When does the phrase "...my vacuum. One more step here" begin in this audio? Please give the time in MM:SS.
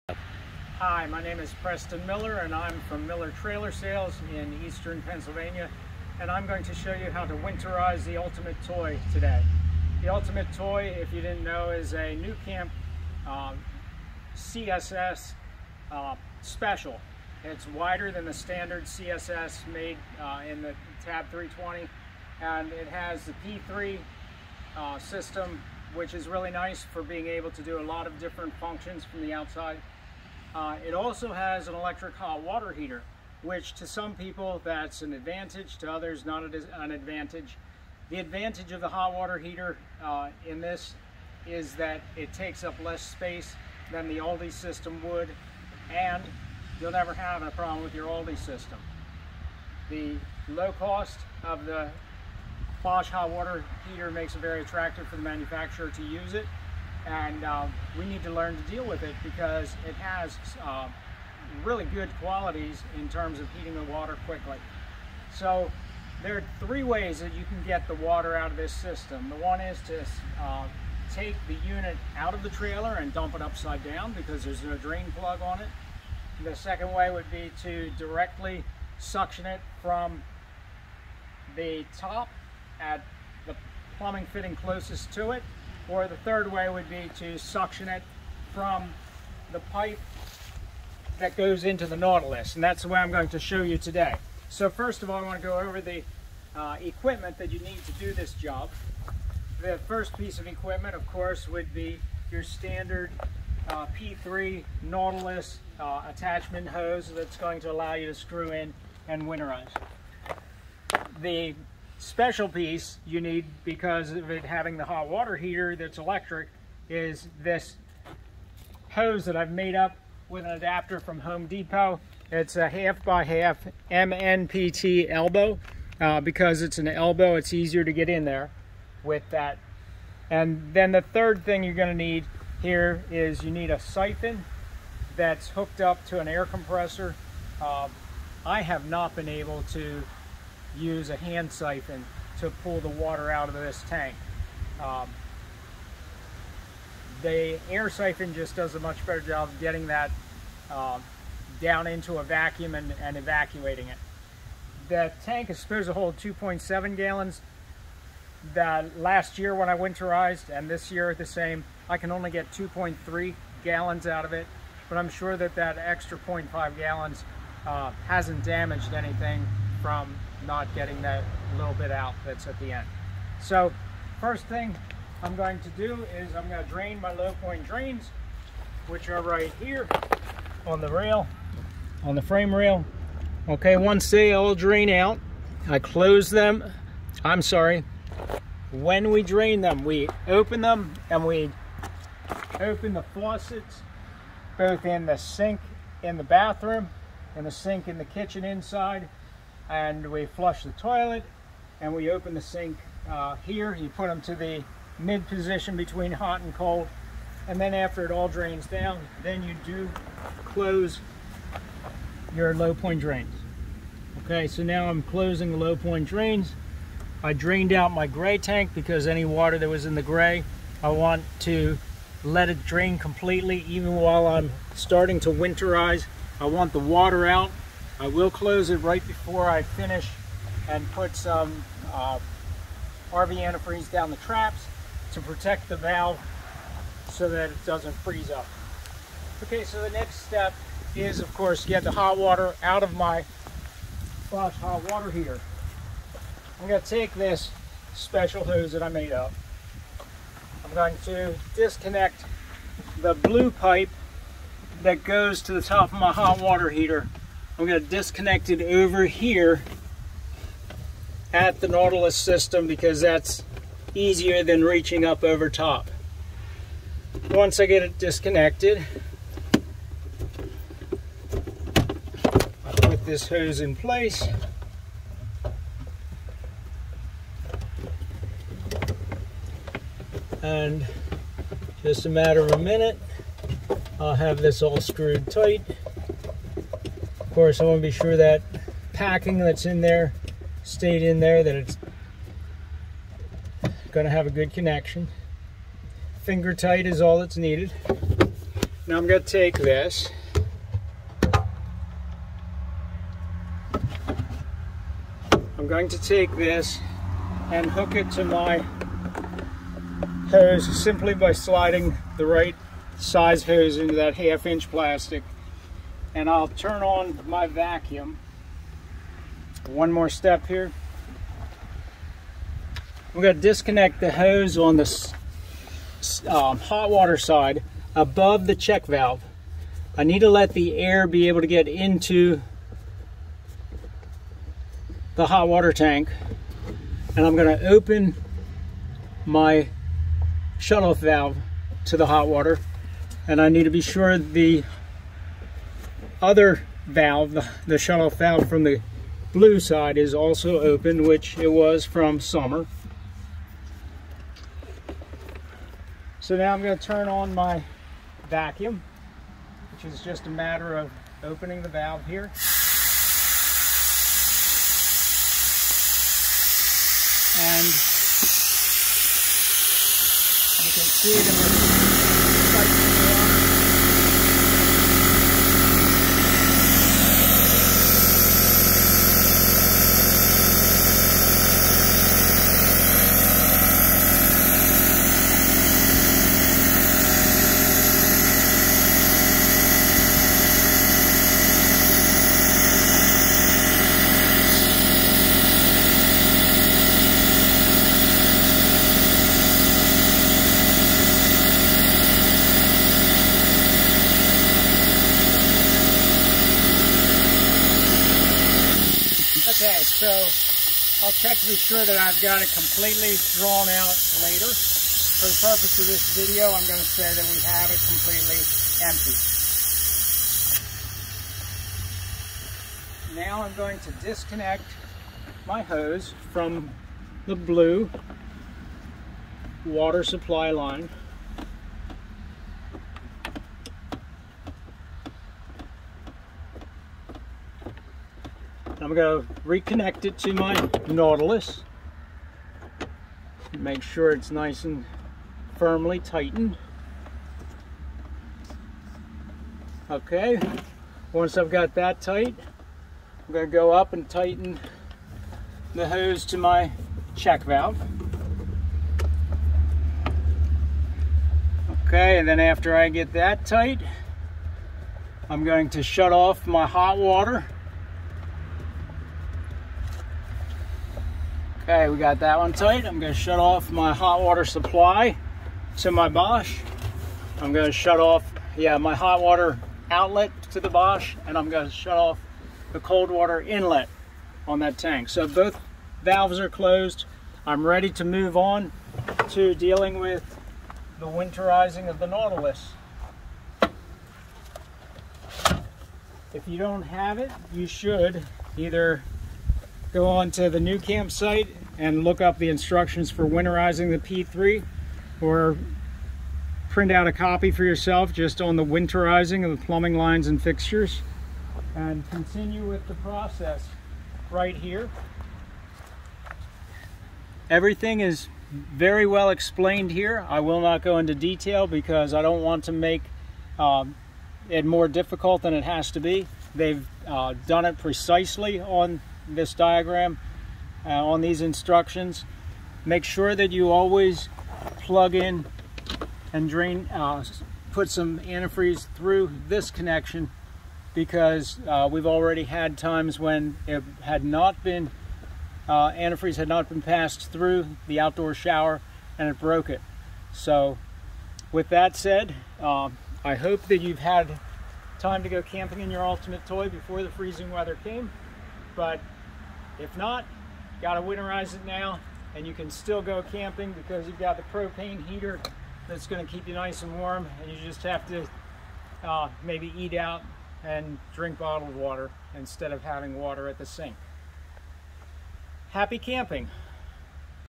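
05:17.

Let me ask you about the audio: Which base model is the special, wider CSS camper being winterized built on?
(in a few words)
Tab 320.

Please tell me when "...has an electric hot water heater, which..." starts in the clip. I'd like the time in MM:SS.
00:31.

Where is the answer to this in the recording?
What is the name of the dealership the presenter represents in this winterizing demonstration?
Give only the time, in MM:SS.
00:03.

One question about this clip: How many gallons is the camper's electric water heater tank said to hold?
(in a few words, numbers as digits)
2.7 gallons.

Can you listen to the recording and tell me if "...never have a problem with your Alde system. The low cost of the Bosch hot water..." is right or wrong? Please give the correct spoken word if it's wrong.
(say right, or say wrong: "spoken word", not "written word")
right.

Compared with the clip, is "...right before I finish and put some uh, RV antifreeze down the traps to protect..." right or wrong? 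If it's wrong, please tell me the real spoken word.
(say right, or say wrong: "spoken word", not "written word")
right.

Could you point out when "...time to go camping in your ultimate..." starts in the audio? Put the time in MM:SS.
09:14.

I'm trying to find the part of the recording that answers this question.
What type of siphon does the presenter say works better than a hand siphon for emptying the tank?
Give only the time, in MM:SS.
02:27.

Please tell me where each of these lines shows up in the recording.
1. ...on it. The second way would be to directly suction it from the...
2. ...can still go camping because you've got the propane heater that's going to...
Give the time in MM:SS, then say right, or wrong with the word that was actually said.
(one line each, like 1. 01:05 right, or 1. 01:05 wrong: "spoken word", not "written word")
1. 01:15 right
2. 09:22 right.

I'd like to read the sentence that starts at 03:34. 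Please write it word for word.
Okay, so now I'm closing the low point drains.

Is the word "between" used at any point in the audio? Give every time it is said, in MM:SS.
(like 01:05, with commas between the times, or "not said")
03:25.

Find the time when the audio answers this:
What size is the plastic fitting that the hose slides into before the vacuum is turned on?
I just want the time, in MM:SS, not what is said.
05:14.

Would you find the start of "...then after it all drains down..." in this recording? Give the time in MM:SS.
03:27.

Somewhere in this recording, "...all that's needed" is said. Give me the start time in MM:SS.
04:57.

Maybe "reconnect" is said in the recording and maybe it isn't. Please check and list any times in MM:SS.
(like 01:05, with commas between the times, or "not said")
07:19.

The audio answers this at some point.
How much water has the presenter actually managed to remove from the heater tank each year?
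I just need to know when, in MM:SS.
02:42.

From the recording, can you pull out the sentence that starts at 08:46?
They've uh, done it precisely on this diagram uh, on these instructions.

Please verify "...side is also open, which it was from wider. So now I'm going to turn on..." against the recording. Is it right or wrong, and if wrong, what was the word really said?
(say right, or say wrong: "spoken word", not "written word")
wrong: "summer", not "wider".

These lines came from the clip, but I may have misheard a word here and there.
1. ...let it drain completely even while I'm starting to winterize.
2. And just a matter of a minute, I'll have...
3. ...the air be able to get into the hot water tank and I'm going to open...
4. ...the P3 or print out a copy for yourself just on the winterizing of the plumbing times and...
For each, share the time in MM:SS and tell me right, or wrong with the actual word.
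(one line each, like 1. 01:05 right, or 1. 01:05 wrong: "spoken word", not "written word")
1. 03:42 right
2. 04:40 right
3. 05:30 right
4. 08:23 wrong: "lines", not "times".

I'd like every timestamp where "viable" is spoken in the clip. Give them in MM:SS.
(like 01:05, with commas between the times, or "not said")
not said.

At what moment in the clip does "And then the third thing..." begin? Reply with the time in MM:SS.
02:10.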